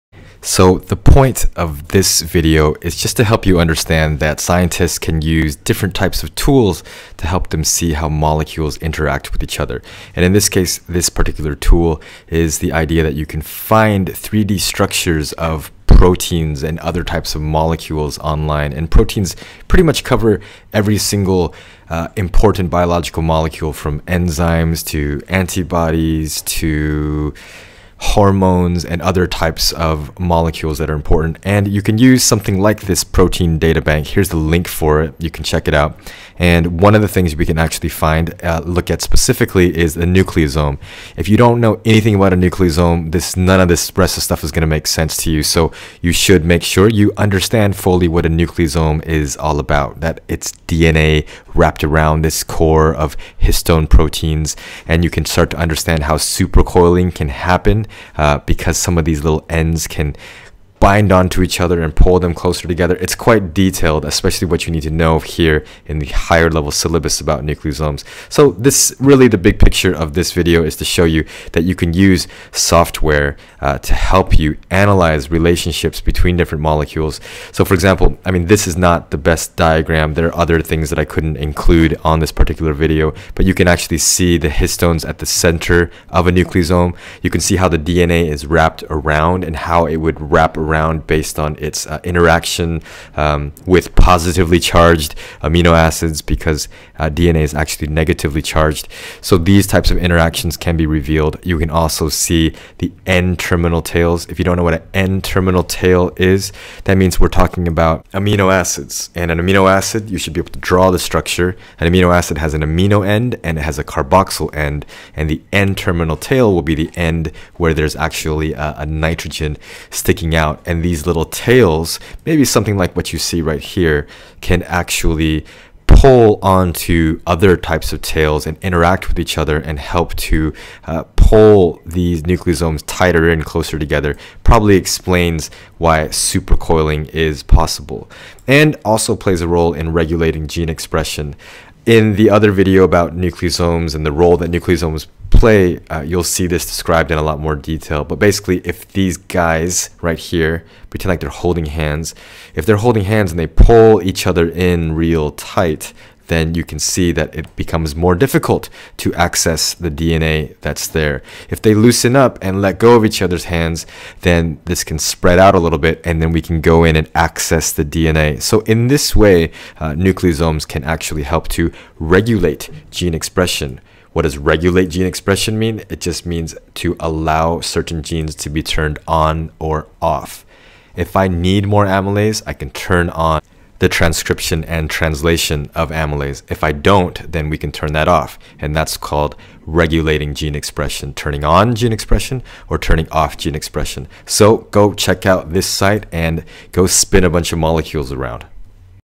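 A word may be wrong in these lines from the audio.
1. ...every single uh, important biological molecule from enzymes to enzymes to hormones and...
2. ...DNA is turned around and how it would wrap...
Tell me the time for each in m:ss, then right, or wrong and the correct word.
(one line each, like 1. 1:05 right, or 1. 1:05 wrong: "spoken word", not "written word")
1. 0:20 wrong: "antibodies", not "enzymes"
2. 1:27 wrong: "wrapped", not "turned".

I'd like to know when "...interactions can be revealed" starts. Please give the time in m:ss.
1:39.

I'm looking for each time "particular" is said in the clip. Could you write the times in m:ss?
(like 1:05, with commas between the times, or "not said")
0:11, 1:22.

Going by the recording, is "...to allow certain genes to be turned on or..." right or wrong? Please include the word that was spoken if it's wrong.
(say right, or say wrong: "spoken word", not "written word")
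right.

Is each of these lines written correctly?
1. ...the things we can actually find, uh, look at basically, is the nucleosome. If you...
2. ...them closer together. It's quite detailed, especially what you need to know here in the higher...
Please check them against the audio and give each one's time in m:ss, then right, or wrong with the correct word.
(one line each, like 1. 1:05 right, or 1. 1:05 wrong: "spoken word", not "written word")
1. 0:37 wrong: "specifically", not "basically"
2. 1:02 right.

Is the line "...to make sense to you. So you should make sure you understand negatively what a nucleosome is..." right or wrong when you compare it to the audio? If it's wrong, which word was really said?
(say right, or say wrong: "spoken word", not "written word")
wrong: "fully", not "negatively".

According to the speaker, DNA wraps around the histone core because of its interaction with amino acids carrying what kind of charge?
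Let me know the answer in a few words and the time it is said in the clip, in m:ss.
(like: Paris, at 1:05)
Positively charged, at 1:33.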